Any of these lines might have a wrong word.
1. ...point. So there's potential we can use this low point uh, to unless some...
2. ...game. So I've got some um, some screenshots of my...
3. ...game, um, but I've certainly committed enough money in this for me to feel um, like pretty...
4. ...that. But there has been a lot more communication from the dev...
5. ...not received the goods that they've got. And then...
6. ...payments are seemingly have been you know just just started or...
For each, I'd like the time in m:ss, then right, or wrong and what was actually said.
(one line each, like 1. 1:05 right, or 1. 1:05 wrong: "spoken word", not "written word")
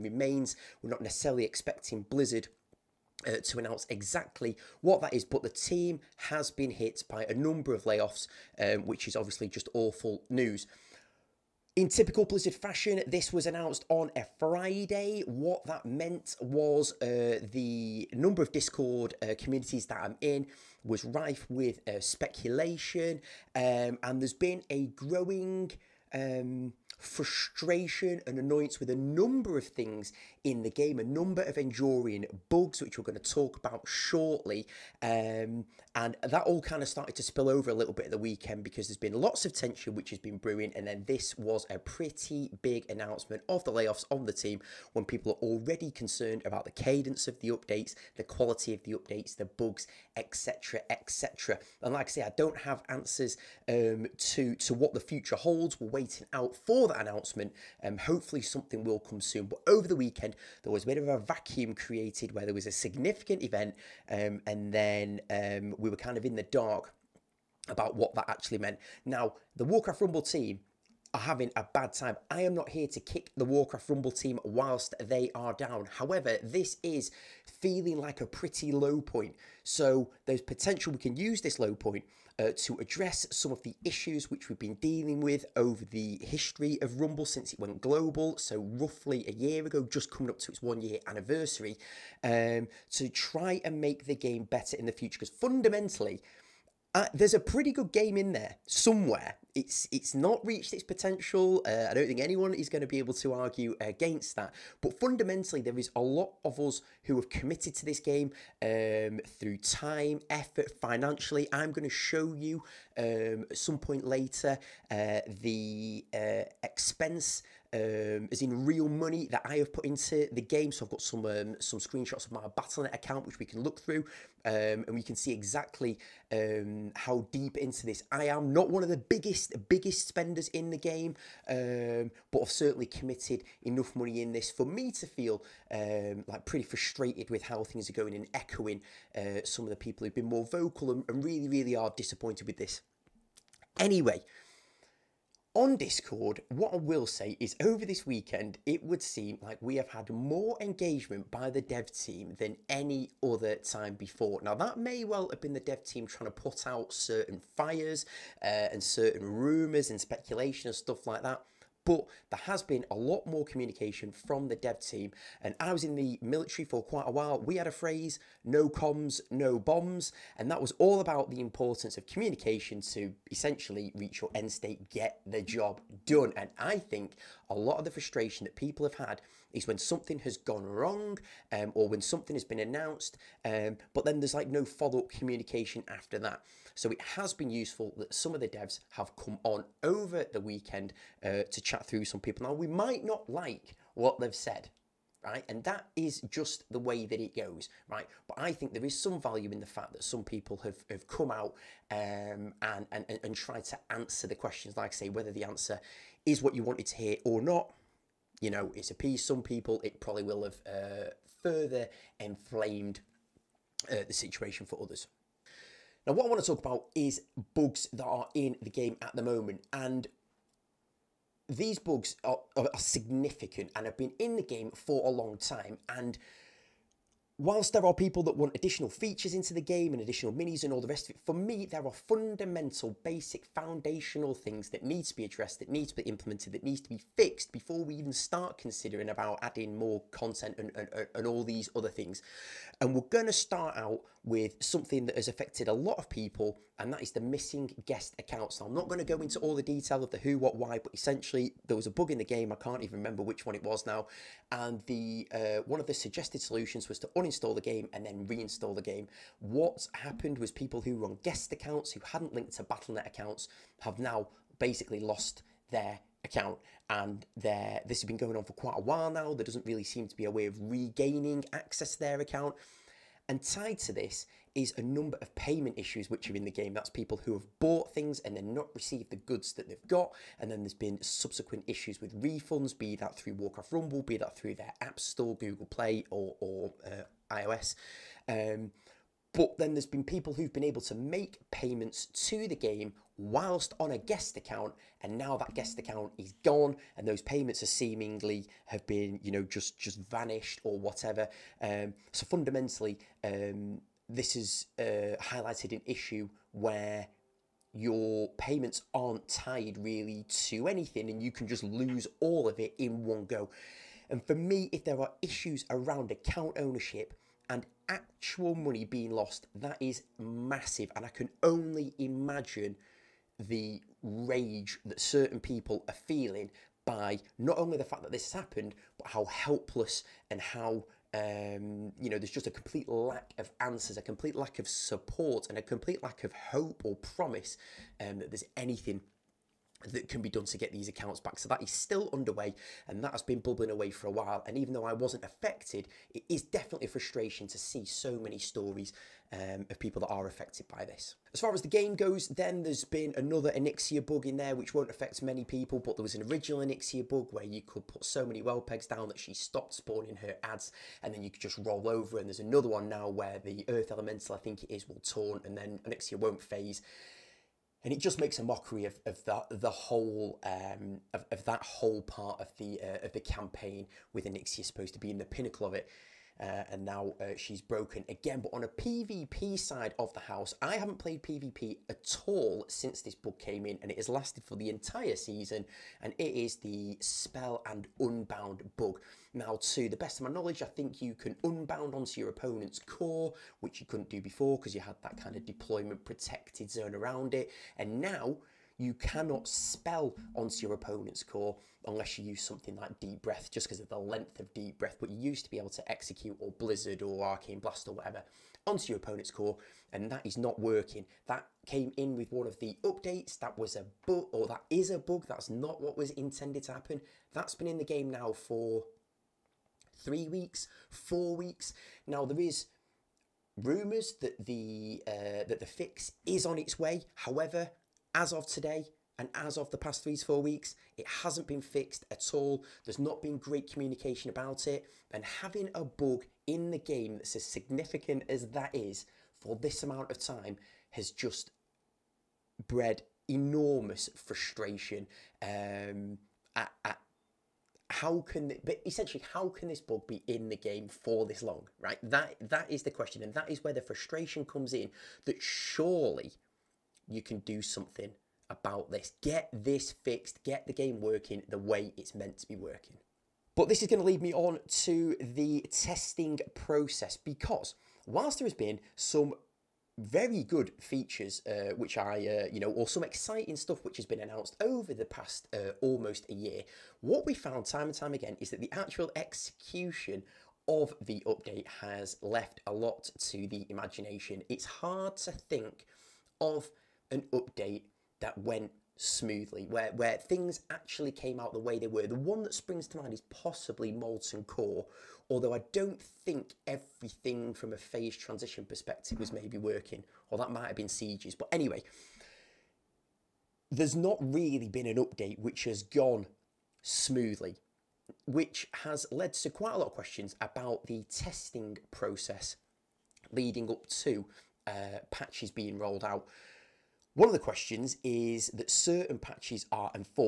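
1. 1:19 wrong: "address", not "unless"
2. 2:00 right
3. 2:10 right
4. 2:41 right
5. 4:38 right
6. 4:57 wrong: "vanished", not "started".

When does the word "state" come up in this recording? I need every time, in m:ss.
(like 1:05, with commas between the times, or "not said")
2:54.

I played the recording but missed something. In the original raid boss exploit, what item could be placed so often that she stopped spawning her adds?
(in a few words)
Whelp eggs.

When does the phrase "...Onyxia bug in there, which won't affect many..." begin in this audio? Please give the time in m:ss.
5:53.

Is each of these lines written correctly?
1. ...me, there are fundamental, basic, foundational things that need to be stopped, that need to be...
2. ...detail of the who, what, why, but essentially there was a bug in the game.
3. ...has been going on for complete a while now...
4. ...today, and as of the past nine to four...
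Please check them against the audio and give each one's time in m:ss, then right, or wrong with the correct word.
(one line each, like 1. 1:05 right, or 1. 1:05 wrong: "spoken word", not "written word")
1. 3:51 wrong: "addressed", not "stopped"
2. 4:09 right
3. 4:28 wrong: "quite", not "complete"
4. 7:08 wrong: "three", not "nine".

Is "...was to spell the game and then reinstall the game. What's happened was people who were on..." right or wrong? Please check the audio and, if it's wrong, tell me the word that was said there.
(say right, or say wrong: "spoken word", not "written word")
wrong: "uninstall", not "spell".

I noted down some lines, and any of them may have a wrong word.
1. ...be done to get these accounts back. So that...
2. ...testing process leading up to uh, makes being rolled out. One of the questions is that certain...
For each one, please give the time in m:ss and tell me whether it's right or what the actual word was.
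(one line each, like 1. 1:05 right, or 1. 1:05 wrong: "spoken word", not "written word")
1. 5:40 right
2. 8:31 wrong: "patches", not "makes".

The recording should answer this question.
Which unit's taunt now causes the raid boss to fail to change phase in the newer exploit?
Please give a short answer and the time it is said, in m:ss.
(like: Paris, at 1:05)
Earth Elemental, at 6:03.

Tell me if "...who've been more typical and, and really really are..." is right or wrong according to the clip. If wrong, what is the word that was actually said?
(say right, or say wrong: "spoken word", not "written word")
wrong: "vocal", not "typical".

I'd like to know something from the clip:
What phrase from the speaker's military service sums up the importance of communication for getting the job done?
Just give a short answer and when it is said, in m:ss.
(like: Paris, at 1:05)
No comms, no bombs, at 2:48.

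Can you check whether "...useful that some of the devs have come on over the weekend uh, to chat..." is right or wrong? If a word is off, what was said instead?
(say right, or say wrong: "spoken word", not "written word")
right.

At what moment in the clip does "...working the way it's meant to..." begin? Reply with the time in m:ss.
7:41.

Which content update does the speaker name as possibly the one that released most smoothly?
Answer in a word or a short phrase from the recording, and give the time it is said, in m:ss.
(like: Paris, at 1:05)
Molten Core, at 8:13.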